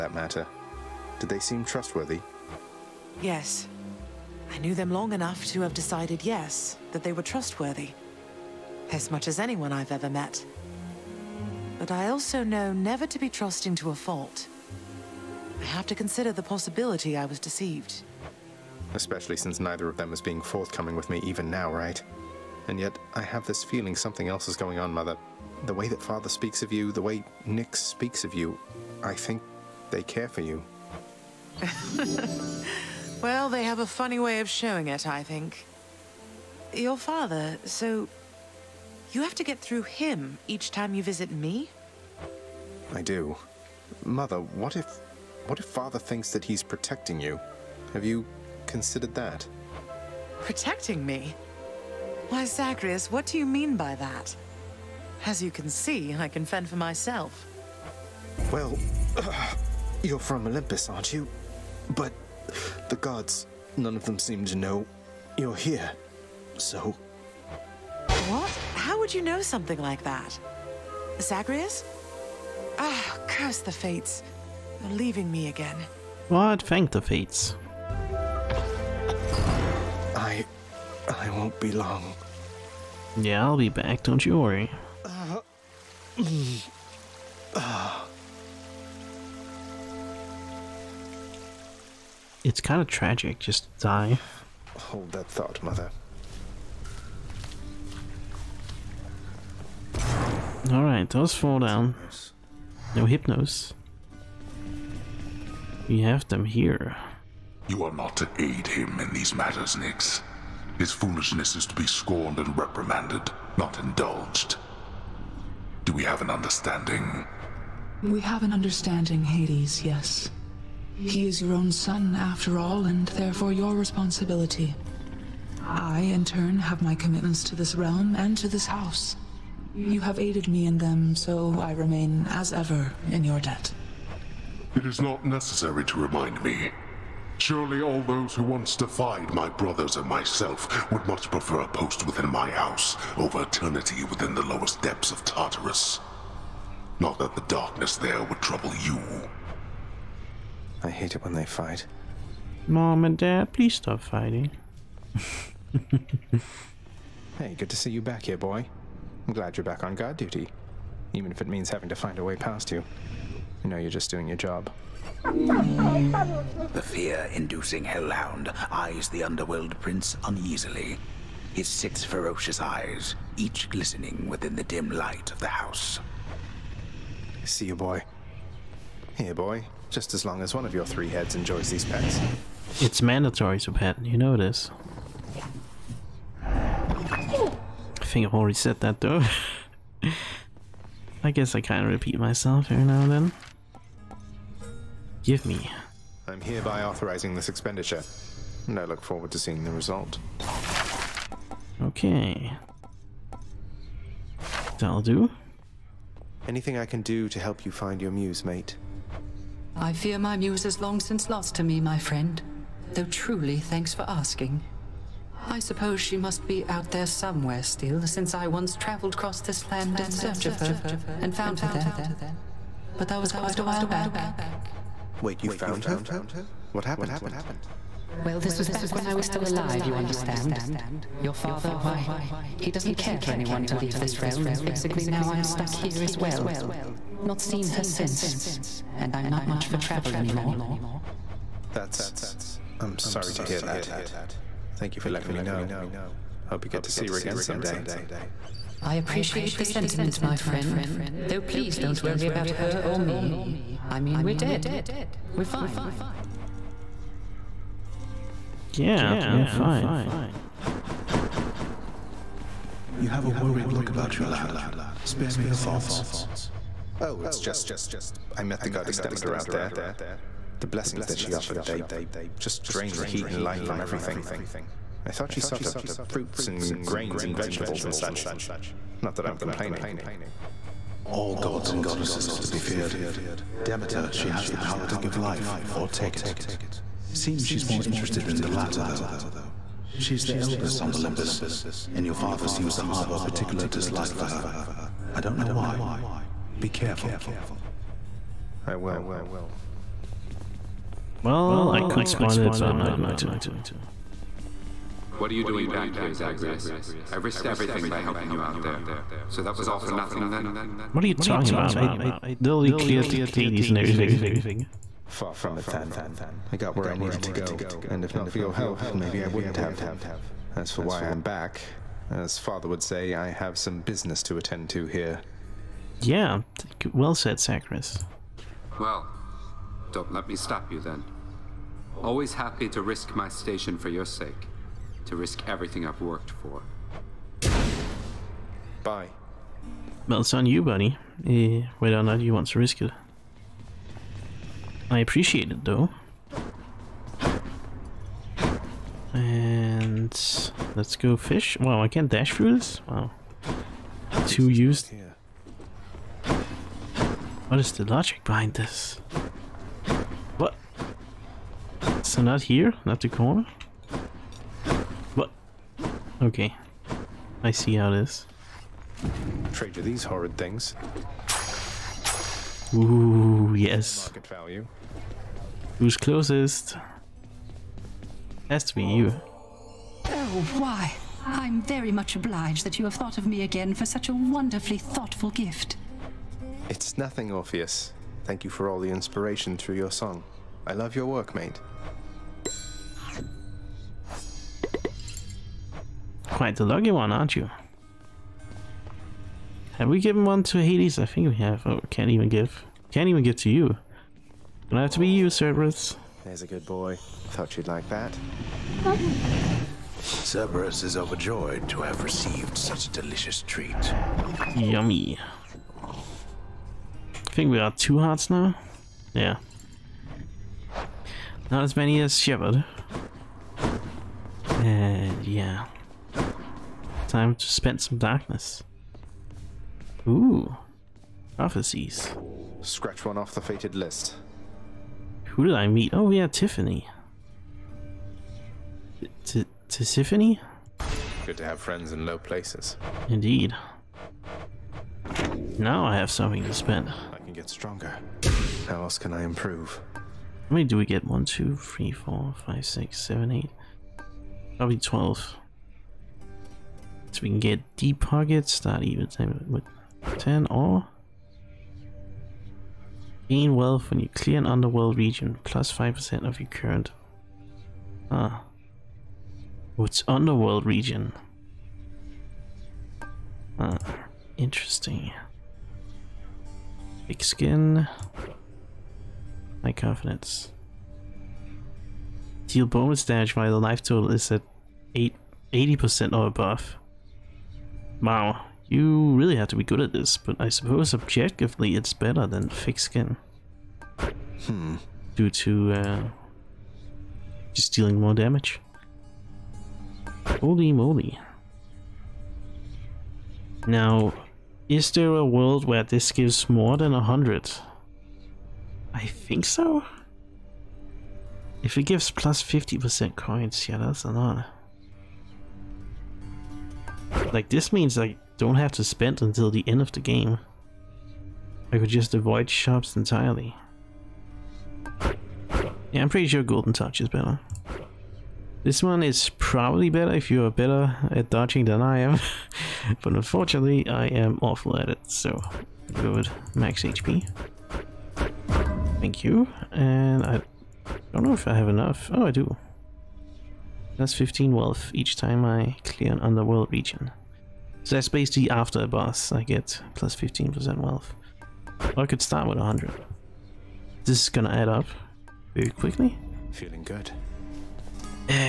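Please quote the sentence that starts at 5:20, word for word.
As for why I'm back, as father would say, I have some business to attend to here.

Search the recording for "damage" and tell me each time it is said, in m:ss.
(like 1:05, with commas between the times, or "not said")
8:03, 8:18.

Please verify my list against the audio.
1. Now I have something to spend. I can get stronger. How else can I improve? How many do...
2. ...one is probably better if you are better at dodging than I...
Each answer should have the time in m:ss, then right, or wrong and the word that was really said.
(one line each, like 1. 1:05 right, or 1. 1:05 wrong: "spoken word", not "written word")
1. 7:25 right
2. 8:48 right.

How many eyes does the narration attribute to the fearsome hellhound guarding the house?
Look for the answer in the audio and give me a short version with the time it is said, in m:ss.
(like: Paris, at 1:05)
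6, at 2:51.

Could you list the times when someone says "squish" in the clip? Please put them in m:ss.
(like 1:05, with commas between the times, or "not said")
not said.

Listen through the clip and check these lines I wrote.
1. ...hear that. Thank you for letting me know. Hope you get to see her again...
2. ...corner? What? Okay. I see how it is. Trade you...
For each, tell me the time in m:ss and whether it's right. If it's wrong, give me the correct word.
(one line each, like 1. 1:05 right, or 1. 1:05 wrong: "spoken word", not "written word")
1. 4:03 right
2. 6:03 right.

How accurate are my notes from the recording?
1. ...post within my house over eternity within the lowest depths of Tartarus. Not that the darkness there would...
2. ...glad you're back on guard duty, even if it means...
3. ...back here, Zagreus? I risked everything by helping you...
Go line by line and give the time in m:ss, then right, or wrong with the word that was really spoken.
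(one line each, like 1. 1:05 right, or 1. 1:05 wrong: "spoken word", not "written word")
1. 2:21 right
2. 2:39 right
3. 5:05 right.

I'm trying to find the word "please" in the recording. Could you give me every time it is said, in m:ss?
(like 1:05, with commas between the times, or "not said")
2:33, 4:11.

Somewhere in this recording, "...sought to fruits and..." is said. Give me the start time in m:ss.
4:35.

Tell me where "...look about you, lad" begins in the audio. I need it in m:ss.
4:23.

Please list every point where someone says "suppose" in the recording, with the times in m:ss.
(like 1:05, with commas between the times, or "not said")
3:35, 8:10.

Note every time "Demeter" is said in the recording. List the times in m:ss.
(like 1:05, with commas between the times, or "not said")
4:28, 4:43.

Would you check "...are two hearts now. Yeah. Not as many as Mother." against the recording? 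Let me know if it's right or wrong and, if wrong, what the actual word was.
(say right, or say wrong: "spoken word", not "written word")
wrong: "Shepard", not "Mother".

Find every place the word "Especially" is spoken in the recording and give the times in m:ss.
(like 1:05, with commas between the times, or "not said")
0:18.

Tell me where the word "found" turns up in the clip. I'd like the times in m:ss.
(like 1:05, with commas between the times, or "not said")
3:41, 3:45.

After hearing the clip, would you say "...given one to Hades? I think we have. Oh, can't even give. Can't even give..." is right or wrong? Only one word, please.
right.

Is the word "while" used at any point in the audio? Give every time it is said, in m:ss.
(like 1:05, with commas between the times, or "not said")
3:43, 8:03.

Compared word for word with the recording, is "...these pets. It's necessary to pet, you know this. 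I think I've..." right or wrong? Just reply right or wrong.
wrong.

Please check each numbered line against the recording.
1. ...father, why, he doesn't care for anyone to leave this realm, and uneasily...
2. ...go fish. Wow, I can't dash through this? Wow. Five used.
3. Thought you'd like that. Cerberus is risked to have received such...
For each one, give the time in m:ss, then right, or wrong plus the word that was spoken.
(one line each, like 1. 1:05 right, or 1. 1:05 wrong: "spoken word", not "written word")
1. 3:51 wrong: "basically", not "uneasily"
2. 5:50 wrong: "Two", not "Five"
3. 6:47 wrong: "overjoyed", not "risked".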